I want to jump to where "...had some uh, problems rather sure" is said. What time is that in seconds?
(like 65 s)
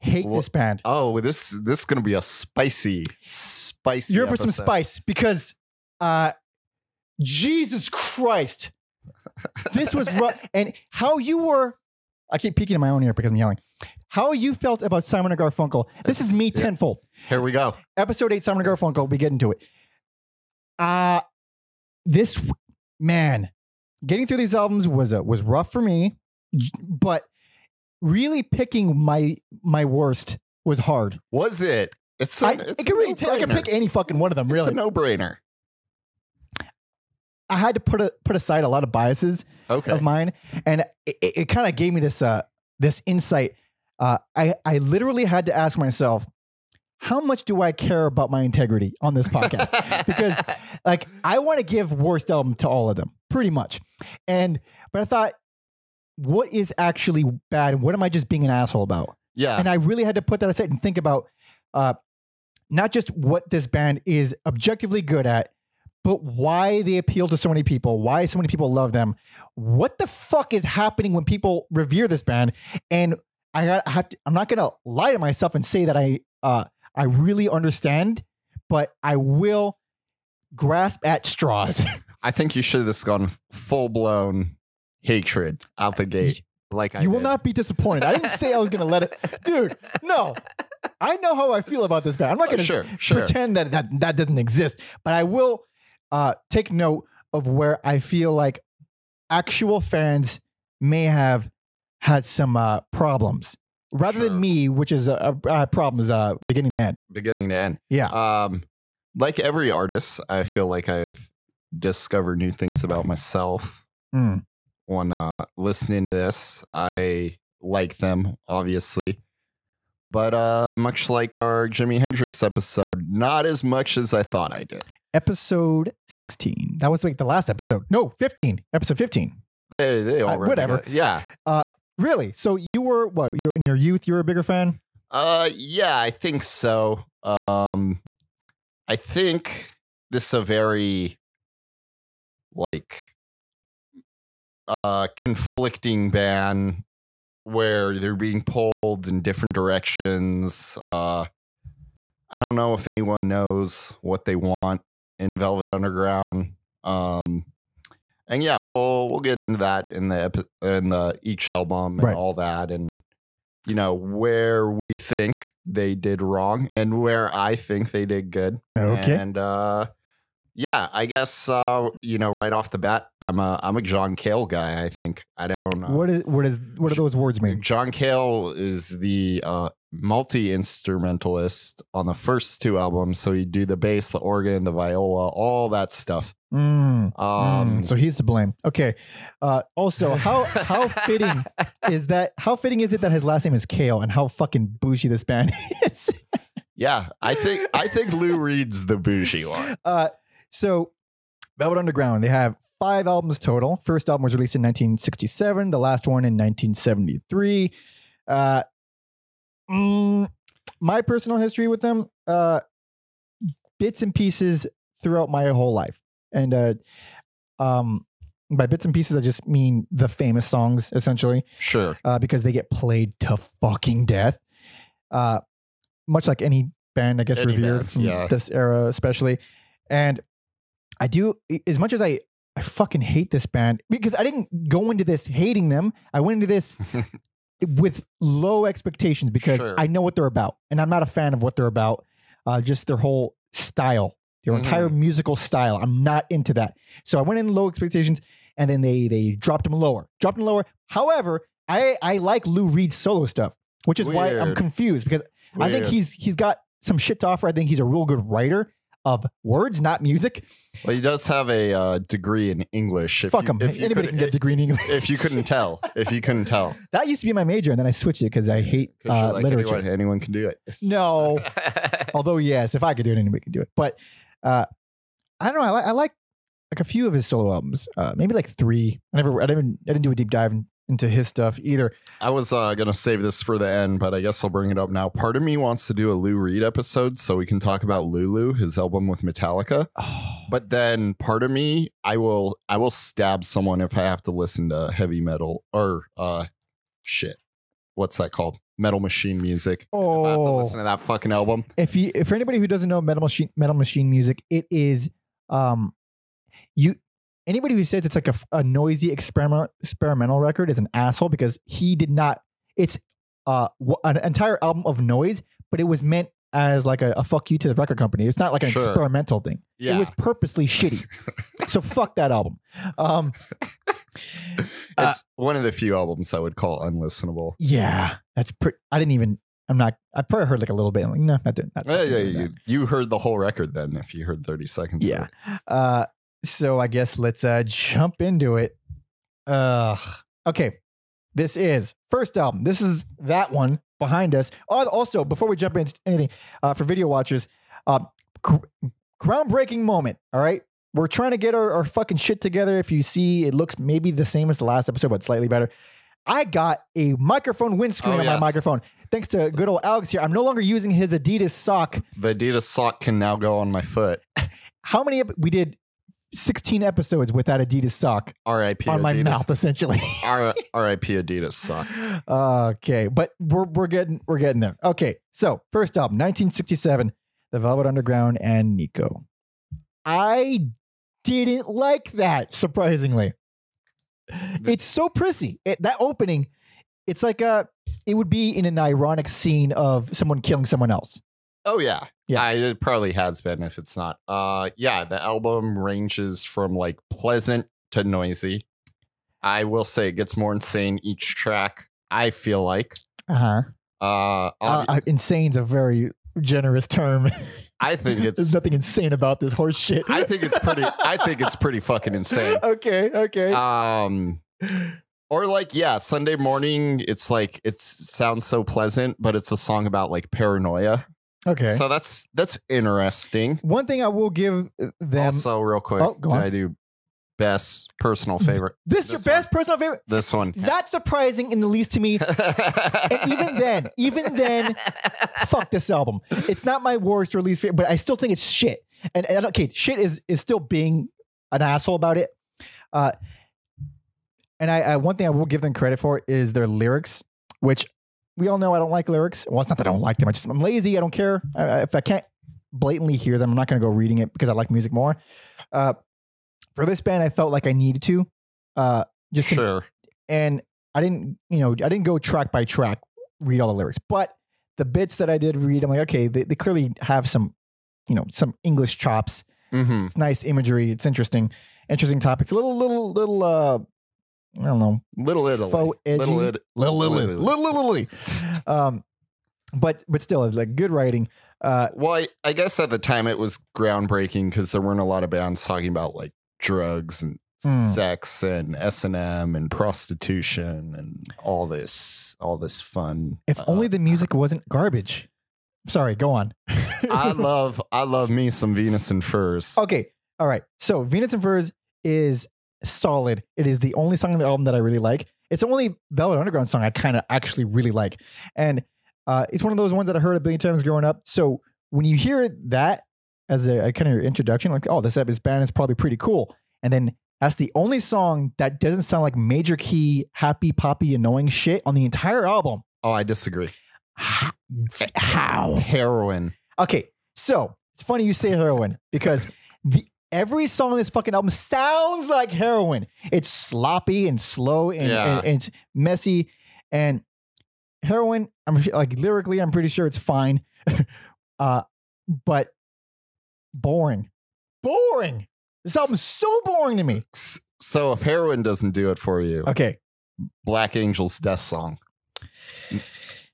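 102 s.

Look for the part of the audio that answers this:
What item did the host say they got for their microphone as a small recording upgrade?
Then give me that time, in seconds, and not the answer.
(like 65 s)
357 s.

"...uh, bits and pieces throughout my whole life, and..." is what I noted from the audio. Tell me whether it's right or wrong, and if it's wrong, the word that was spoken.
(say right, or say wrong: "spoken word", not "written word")
right.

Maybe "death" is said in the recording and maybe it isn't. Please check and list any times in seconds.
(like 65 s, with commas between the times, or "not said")
224 s, 551 s.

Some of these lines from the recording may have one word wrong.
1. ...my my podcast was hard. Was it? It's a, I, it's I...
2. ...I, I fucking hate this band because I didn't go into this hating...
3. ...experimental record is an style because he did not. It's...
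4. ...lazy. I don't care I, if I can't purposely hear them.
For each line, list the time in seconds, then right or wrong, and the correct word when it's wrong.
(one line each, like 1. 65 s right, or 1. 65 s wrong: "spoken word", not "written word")
1. 28 s wrong: "worst", not "podcast"
2. 232 s right
3. 309 s wrong: "asshole", not "style"
4. 450 s wrong: "blatantly", not "purposely".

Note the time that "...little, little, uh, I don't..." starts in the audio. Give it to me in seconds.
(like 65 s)
472 s.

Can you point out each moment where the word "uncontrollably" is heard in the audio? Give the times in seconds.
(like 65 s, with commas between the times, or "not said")
not said.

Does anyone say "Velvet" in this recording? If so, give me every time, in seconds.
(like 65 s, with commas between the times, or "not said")
155 s, 201 s, 377 s, 506 s.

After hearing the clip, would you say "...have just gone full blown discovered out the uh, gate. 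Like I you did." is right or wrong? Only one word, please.
wrong.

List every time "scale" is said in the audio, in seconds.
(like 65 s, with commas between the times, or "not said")
not said.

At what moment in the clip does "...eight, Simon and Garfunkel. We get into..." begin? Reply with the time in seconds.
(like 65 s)
18 s.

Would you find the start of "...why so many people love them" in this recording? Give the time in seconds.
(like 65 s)
68 s.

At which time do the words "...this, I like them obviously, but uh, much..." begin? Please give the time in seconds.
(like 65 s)
116 s.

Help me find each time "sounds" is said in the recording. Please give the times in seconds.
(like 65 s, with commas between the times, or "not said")
417 s, 519 s, 531 s.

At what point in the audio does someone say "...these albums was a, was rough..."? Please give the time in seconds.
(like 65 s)
24 s.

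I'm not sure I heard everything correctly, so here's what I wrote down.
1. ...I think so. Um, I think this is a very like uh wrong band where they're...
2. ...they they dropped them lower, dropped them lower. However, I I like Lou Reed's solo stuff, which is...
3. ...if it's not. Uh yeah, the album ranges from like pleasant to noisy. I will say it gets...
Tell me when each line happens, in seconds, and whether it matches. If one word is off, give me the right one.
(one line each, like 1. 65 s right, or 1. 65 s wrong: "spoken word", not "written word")
1. 135 s wrong: "conflicting", not "wrong"
2. 248 s right
3. 393 s right.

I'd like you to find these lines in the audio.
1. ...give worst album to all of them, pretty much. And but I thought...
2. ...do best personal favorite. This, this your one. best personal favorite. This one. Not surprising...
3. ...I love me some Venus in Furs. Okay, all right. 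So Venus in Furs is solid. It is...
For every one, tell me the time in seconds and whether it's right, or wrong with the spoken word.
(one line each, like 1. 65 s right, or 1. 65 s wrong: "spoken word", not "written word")
1. 51 s right
2. 426 s right
3. 497 s right.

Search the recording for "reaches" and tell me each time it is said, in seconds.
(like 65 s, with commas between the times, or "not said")
not said.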